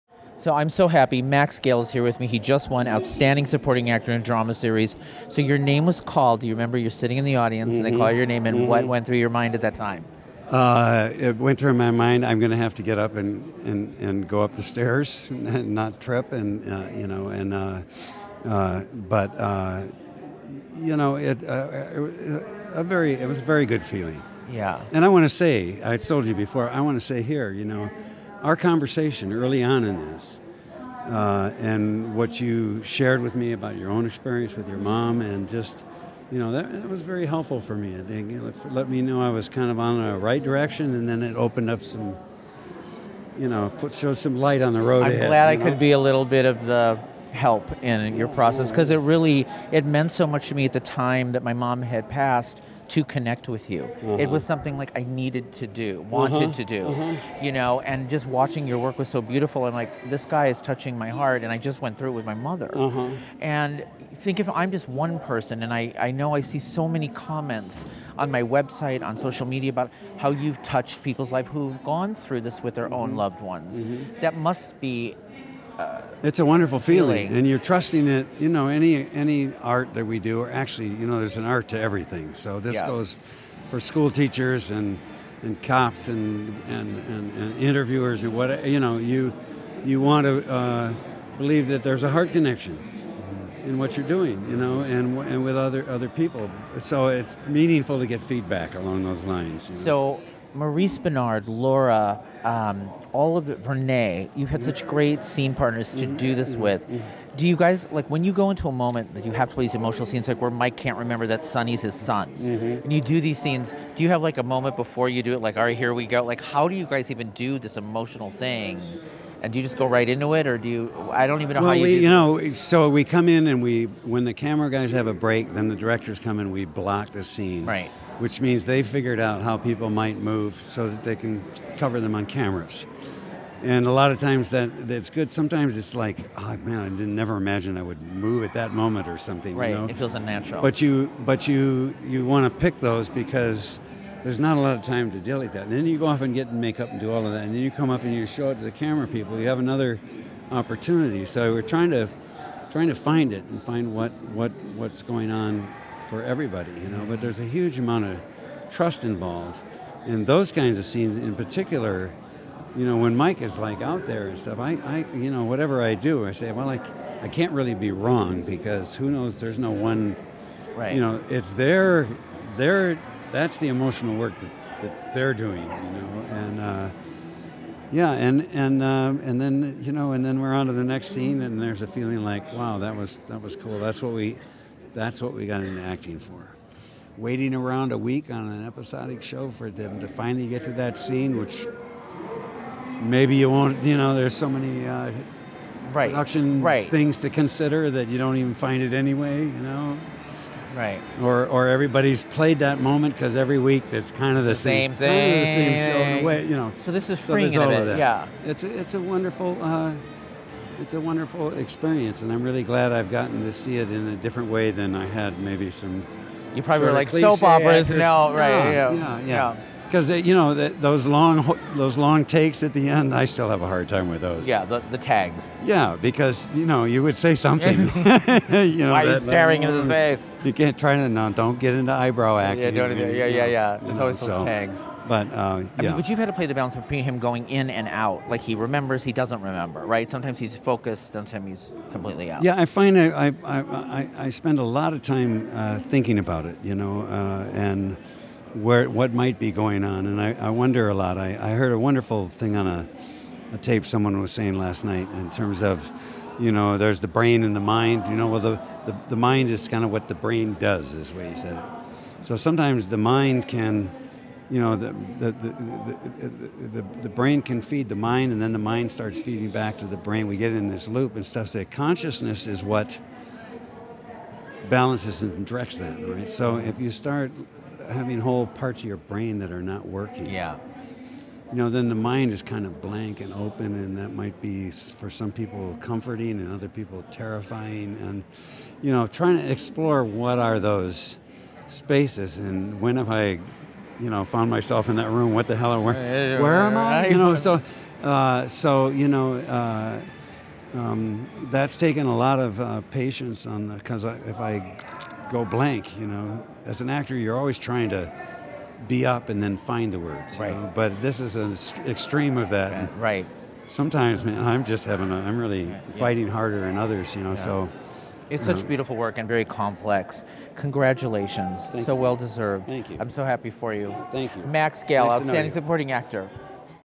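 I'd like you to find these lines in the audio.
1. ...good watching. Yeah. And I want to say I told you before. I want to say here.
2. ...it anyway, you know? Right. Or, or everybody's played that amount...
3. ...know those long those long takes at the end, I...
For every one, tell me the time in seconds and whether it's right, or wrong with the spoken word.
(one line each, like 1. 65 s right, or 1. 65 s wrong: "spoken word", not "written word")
1. 23 s wrong: "feeling", not "watching"
2. 198 s wrong: "moment", not "amount"
3. 220 s right.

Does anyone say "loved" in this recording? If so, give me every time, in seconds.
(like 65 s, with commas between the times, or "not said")
73 s.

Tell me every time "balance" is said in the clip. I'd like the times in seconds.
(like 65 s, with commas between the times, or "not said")
236 s, 274 s.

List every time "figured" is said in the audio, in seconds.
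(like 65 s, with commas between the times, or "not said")
128 s.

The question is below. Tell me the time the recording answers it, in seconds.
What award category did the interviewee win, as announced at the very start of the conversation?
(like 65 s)
2 s.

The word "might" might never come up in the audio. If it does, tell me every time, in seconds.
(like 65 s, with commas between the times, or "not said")
129 s, 249 s, 284 s.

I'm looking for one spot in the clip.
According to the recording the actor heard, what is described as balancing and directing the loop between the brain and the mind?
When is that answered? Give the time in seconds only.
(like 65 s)
271 s.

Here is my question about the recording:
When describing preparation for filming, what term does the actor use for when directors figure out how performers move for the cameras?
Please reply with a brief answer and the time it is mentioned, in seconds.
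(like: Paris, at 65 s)
block the scene, at 126 s.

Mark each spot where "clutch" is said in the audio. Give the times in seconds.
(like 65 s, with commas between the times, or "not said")
not said.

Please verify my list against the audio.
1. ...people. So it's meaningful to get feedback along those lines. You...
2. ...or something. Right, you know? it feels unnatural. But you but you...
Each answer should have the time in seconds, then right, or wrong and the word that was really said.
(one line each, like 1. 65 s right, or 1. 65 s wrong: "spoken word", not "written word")
1. 96 s right
2. 139 s right.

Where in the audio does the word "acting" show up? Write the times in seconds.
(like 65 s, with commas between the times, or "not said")
185 s, 232 s.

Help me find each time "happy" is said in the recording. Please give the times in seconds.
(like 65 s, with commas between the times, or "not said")
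0 s, 323 s.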